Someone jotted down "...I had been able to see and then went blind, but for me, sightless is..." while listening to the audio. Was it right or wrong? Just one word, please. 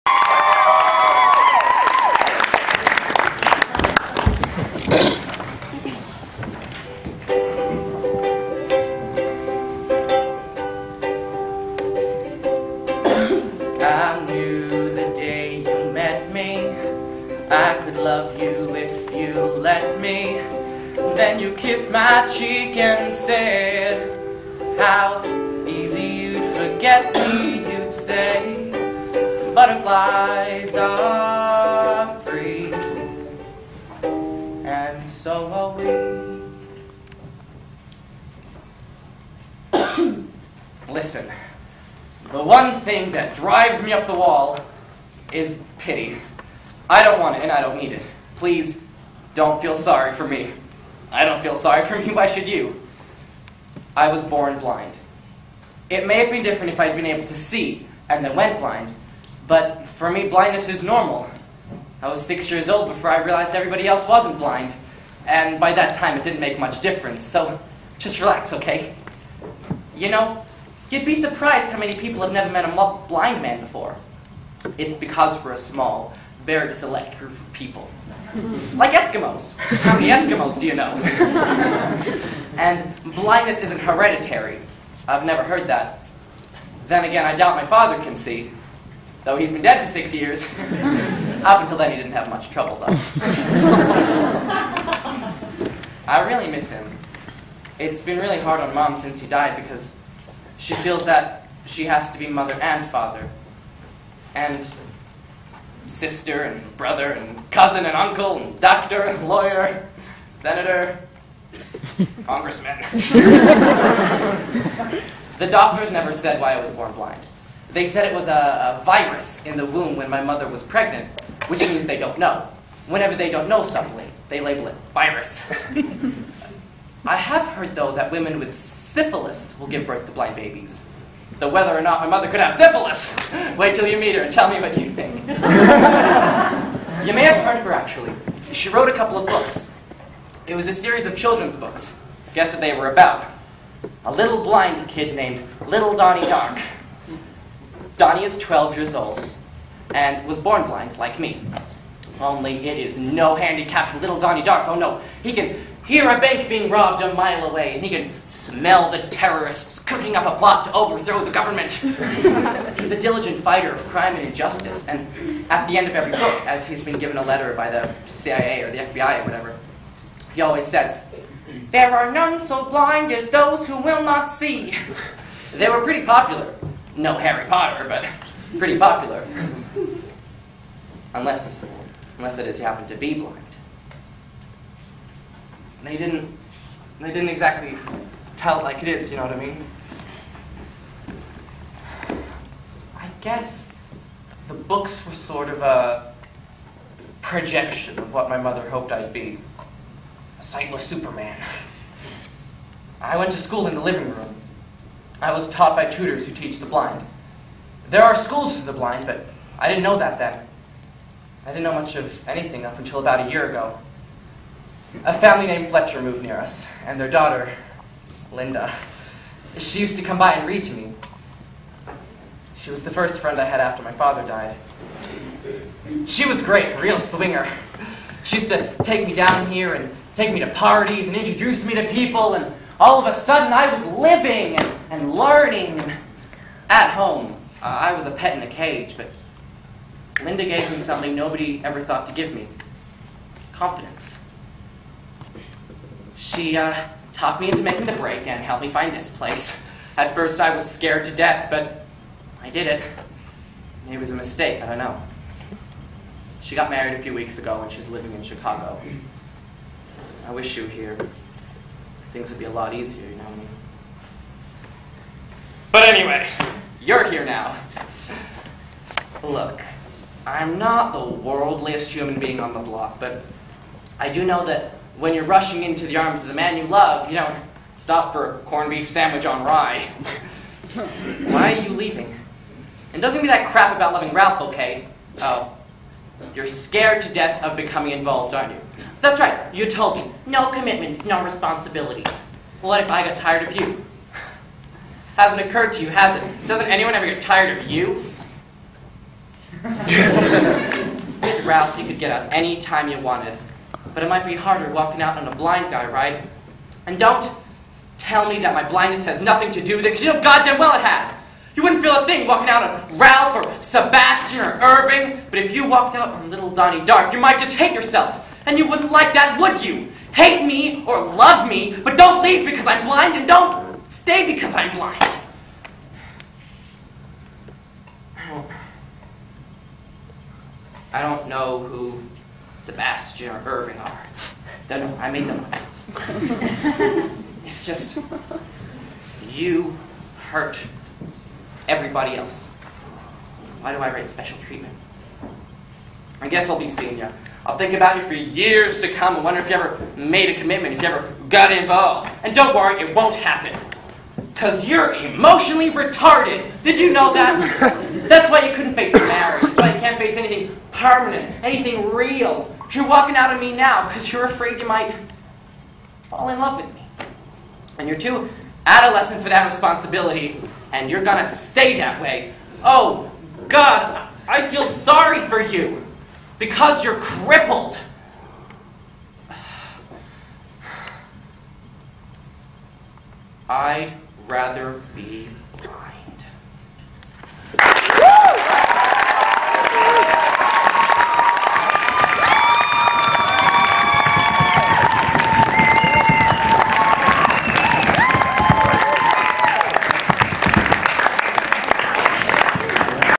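wrong.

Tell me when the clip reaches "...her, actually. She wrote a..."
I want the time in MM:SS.
02:17.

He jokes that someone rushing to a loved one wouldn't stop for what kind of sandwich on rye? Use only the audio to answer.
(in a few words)
corned beef.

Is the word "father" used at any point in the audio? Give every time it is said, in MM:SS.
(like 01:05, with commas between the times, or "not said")
01:27, 01:42, 03:43.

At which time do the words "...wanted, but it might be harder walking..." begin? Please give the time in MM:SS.
05:02.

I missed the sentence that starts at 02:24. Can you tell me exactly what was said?
A little blind kid named Little Donnie Dark.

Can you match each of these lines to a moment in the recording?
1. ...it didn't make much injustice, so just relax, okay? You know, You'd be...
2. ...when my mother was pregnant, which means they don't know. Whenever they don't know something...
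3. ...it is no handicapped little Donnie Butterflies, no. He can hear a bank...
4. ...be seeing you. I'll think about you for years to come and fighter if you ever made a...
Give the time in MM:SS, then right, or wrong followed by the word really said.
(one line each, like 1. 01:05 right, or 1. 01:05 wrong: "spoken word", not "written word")
1. 01:06 wrong: "difference", not "injustice"
2. 01:59 right
3. 02:32 wrong: "Darko", not "Butterflies"
4. 05:46 wrong: "wonder", not "fighter".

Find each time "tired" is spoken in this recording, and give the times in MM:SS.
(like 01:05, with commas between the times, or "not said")
04:53, 04:57.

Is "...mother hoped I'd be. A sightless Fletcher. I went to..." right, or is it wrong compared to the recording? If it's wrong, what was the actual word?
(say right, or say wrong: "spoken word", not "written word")
wrong: "Superman", not "Fletcher".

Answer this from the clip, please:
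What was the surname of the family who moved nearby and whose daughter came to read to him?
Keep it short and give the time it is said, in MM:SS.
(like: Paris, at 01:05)
Fletcher, at 03:35.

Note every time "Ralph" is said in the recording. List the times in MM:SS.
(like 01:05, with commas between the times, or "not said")
04:44, 05:01, 05:12.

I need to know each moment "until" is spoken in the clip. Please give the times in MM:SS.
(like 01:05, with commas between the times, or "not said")
01:31, 03:32.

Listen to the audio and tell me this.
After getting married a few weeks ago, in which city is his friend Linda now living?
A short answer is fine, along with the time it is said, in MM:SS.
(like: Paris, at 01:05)
Chicago, at 04:18.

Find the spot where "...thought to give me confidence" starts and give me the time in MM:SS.
04:01.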